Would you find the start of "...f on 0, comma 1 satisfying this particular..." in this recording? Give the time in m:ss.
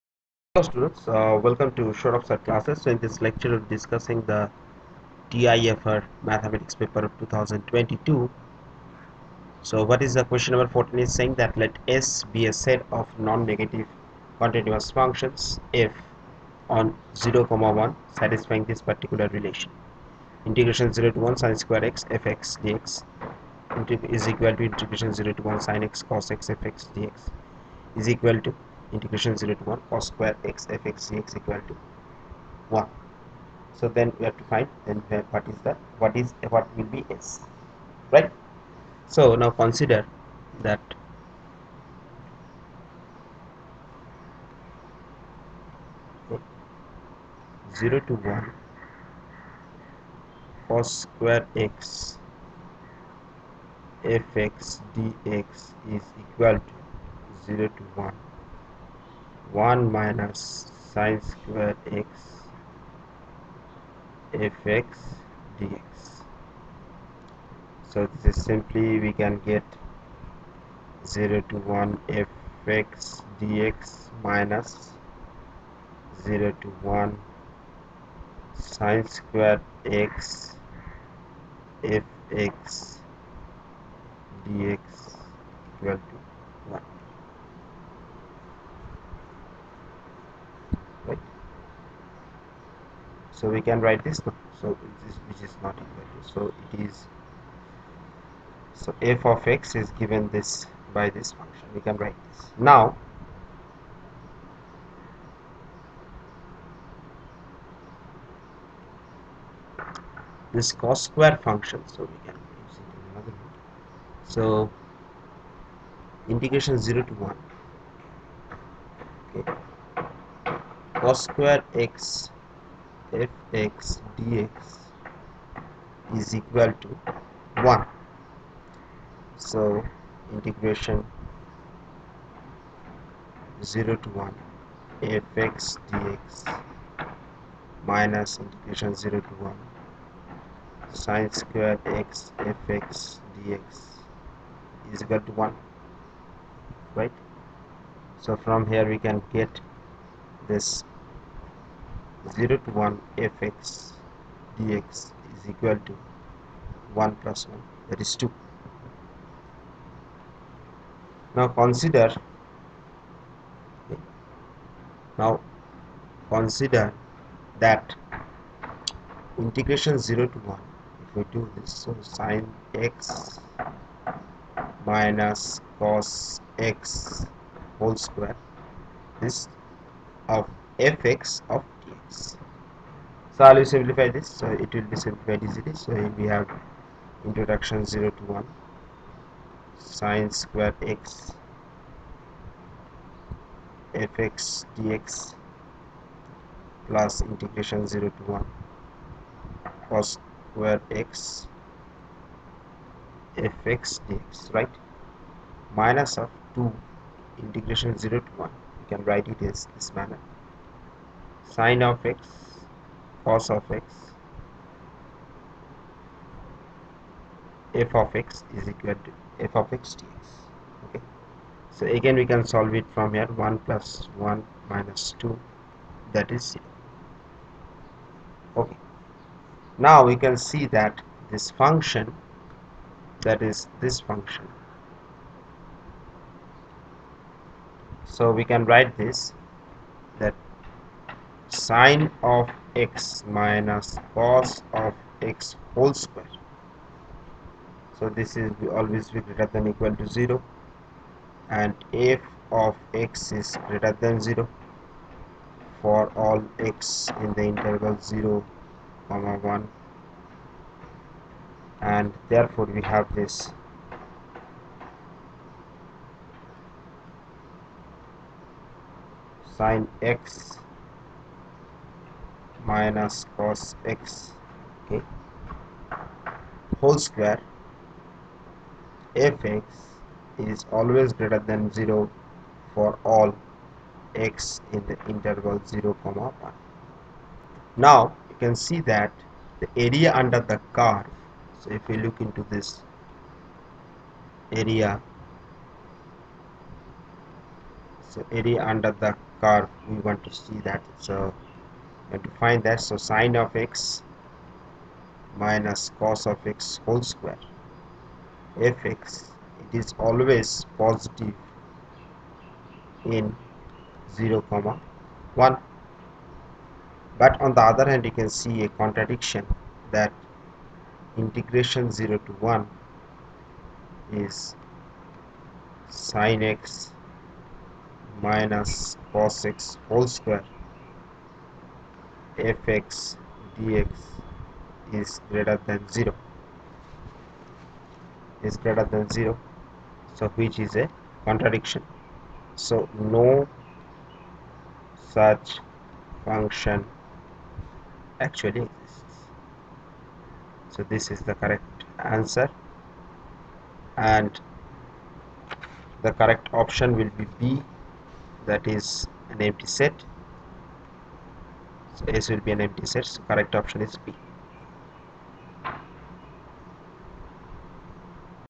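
0:15.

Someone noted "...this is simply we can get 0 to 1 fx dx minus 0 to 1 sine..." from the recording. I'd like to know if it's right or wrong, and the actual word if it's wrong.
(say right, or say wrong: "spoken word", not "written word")
right.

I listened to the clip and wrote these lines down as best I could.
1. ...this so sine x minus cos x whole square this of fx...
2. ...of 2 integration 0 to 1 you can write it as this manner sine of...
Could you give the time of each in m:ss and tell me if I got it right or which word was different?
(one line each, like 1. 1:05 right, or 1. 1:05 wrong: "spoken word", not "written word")
1. 2:51 right
2. 3:26 right.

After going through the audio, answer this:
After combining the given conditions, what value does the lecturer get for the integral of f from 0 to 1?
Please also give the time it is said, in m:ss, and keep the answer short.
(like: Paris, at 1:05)
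2, at 2:37.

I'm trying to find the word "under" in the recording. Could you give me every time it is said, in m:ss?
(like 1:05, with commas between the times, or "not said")
4:50, 4:58.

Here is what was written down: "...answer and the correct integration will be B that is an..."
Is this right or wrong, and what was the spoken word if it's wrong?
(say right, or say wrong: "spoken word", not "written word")
wrong: "option", not "integration".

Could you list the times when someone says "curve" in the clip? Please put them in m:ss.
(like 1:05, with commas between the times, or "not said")
4:50, 4:59.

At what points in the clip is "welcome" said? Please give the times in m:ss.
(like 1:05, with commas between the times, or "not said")
0:01.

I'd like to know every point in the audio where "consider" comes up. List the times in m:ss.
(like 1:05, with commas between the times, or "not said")
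0:39, 2:41, 2:46.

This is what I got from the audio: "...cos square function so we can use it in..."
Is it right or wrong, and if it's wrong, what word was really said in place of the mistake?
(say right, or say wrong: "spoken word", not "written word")
right.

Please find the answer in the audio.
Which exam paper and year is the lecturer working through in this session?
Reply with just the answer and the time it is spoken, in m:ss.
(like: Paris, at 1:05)
TIFR mathematics 2022, at 0:05.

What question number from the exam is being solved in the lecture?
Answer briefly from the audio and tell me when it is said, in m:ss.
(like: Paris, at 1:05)
14, at 0:10.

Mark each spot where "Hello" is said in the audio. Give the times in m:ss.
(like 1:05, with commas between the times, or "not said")
0:00.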